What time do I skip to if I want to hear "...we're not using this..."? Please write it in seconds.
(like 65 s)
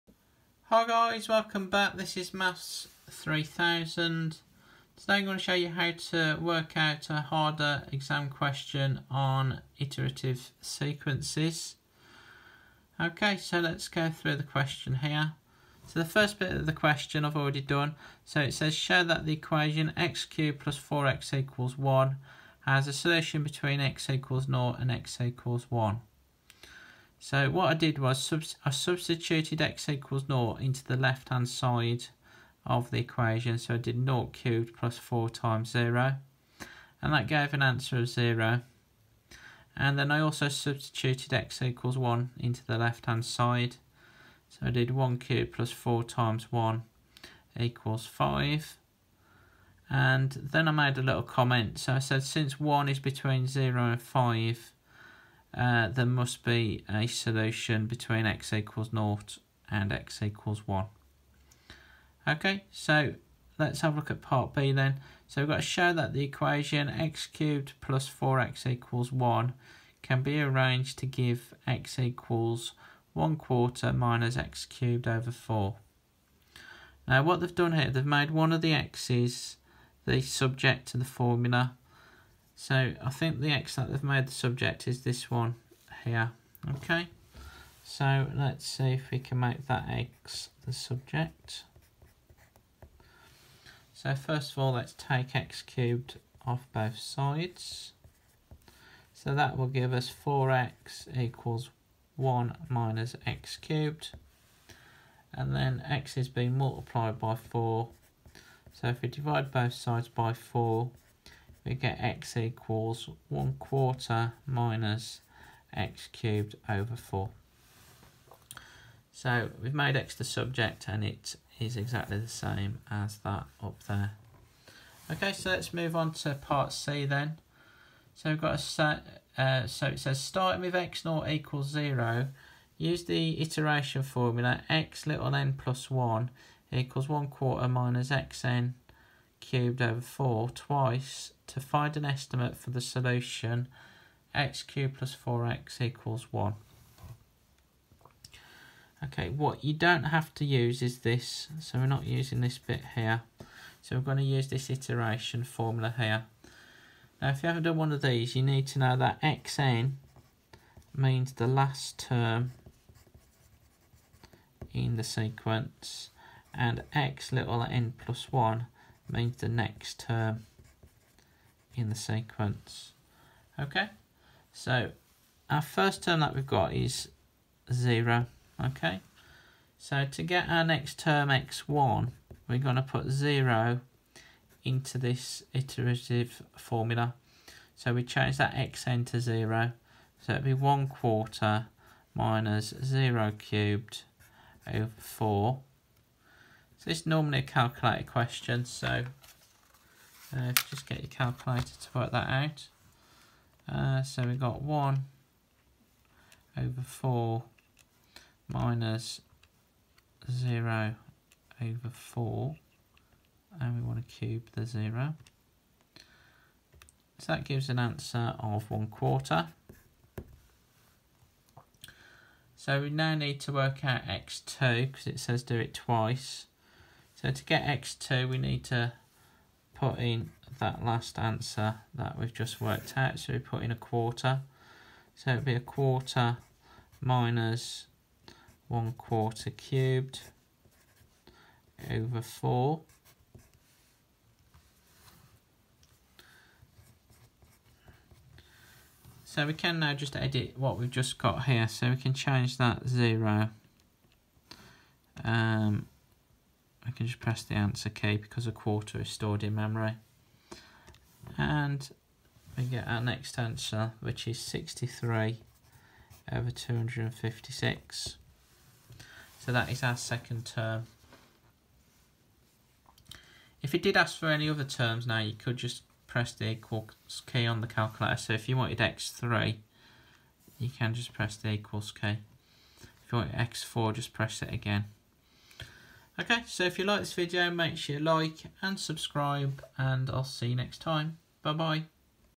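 151 s.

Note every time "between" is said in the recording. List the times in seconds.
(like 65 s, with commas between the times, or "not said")
23 s, 52 s, 57 s.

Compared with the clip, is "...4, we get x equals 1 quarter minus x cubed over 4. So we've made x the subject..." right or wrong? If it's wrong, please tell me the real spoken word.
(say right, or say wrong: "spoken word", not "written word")
right.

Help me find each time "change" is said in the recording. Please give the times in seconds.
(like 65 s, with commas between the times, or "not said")
188 s, 252 s.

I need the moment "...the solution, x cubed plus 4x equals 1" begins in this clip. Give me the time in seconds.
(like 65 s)
142 s.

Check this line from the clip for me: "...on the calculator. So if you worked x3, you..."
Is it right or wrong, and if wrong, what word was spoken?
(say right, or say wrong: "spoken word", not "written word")
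wrong: "wanted", not "worked".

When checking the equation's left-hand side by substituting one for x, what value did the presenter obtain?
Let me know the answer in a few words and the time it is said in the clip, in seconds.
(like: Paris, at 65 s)
5, at 44 s.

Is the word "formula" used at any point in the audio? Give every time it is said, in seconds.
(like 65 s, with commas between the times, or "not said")
81 s, 134 s, 155 s, 186 s.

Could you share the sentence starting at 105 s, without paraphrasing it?
And then x is being multiplied by 4.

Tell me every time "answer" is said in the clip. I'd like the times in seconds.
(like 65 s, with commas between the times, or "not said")
37 s, 217 s, 231 s, 257 s, 263 s.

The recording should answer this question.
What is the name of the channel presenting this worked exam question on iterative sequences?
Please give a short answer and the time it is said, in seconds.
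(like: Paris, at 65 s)
Maths 3000, at 2 s.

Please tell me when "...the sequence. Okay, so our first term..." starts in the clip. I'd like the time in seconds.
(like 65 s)
171 s.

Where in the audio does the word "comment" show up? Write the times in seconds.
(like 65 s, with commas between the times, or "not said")
51 s.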